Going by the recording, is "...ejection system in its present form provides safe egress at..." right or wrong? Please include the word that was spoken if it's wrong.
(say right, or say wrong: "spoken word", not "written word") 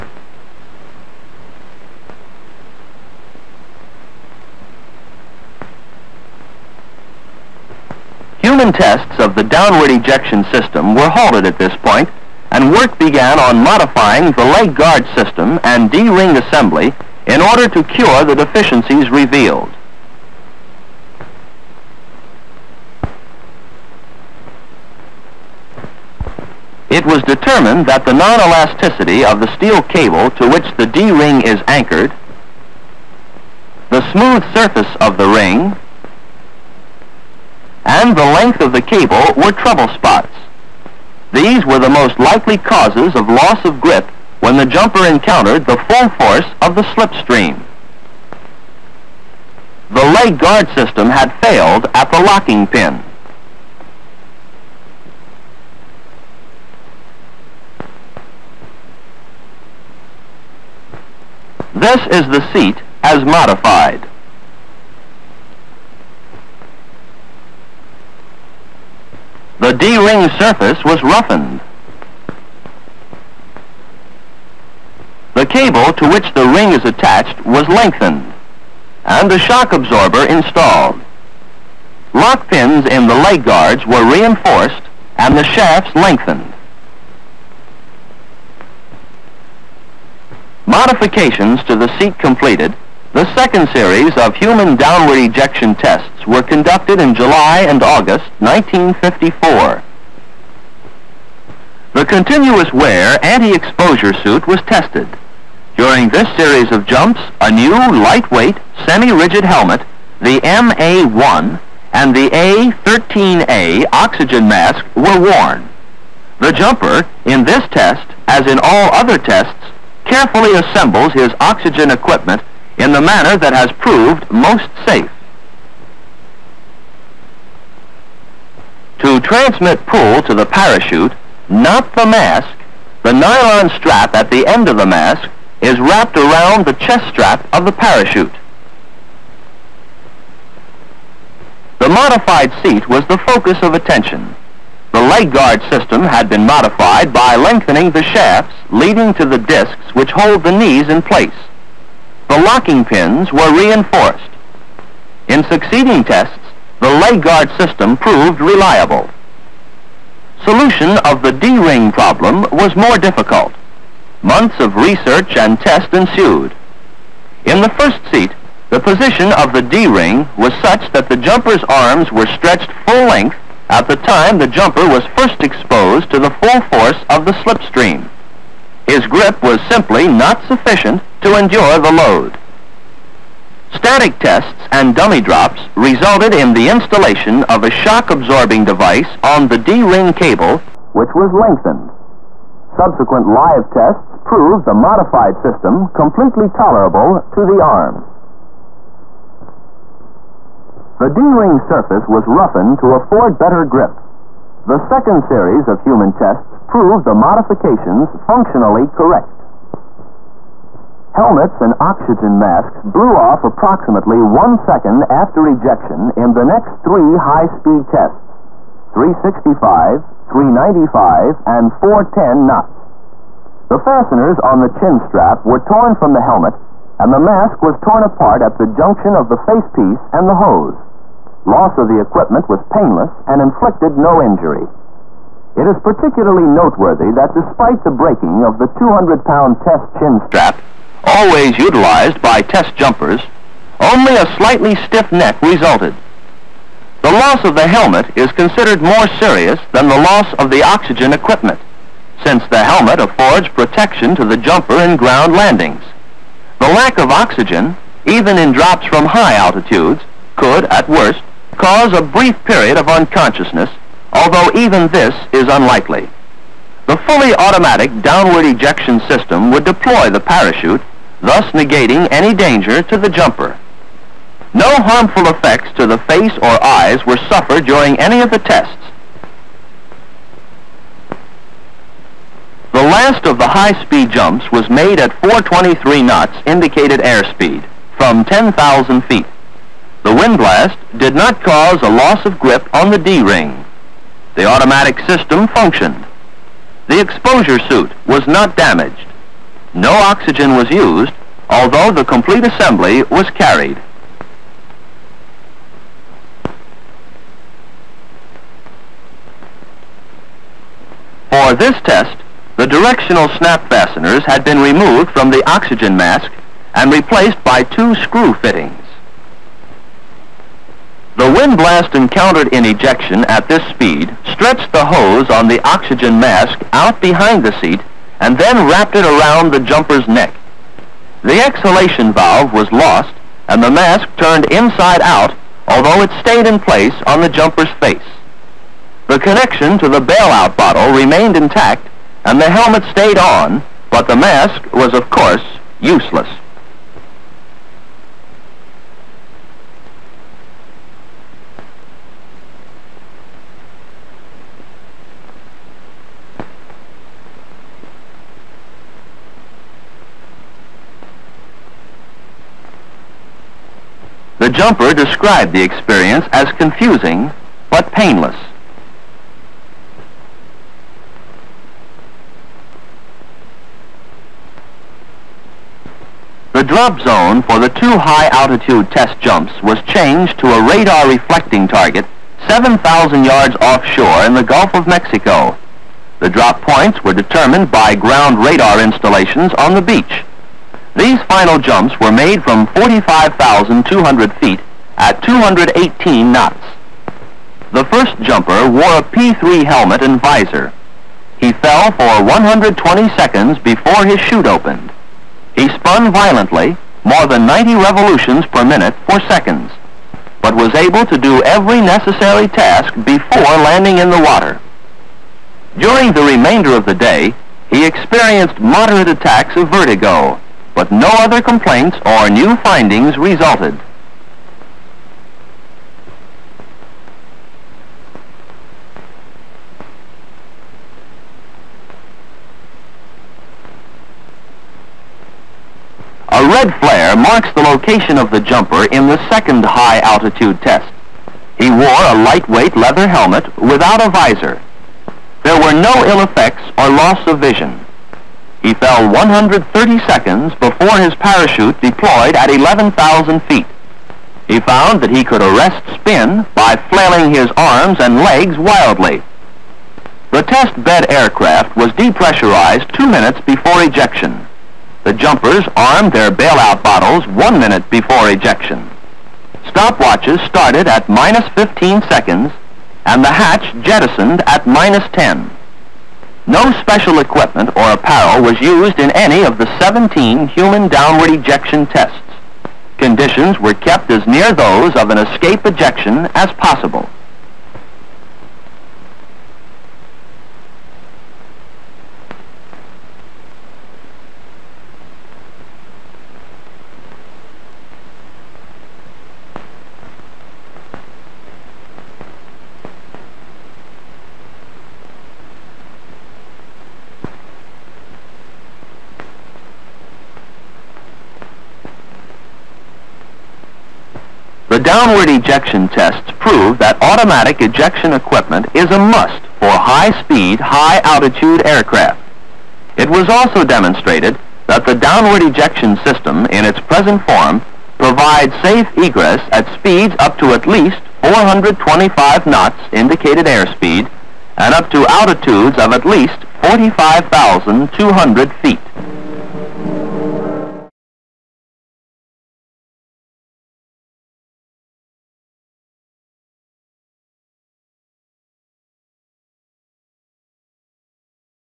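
right.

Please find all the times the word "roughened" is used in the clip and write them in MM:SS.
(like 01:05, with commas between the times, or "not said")
01:11, 03:22.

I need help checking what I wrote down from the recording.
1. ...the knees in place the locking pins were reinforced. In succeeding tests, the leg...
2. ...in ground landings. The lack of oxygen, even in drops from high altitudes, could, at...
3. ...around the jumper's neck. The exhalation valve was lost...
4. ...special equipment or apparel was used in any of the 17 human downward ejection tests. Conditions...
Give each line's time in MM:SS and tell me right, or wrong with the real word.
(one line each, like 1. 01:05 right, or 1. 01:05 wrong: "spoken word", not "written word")
1. 02:30 right
2. 04:14 right
3. 05:29 right
4. 07:56 right.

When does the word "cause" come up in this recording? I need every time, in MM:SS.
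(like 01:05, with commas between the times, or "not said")
00:42, 04:21, 04:51.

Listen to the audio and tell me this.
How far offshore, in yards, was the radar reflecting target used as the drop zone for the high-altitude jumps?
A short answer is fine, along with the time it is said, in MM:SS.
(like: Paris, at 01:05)
7,000 yards, at 06:22.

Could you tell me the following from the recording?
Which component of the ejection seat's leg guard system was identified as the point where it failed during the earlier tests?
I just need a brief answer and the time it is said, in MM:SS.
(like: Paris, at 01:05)
locking pin, at 00:52.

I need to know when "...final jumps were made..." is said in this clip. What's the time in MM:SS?
06:31.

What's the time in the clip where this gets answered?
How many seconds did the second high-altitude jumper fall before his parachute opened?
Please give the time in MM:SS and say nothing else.
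07:29.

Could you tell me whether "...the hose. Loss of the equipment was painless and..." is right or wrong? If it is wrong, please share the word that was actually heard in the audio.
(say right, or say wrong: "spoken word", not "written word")
right.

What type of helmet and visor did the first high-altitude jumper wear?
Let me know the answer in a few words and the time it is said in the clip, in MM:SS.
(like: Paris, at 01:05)
P-3, at 06:39.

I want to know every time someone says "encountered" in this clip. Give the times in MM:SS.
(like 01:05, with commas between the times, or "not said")
00:45, 05:21.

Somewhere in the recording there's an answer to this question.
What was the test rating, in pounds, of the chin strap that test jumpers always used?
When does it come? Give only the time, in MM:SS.
03:58.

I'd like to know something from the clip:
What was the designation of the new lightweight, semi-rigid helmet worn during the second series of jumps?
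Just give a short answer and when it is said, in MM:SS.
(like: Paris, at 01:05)
MA-1, at 01:50.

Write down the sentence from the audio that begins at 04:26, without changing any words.
The fully automatic downward ejection system would deploy the parachute, thus negating any danger to the jumper.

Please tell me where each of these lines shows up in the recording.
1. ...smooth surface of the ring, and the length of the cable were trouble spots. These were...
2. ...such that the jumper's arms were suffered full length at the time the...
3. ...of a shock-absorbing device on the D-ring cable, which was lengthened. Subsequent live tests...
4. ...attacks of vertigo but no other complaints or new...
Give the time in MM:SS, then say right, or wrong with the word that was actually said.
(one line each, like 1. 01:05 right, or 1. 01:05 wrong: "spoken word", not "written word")
1. 00:34 right
2. 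02:50 wrong: "stretched", not "suffered"
3. 03:07 right
4. 06:59 right.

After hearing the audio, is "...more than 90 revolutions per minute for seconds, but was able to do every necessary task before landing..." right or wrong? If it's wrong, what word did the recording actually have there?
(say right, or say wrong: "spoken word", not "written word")
right.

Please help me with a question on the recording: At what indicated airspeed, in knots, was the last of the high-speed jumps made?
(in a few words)
423.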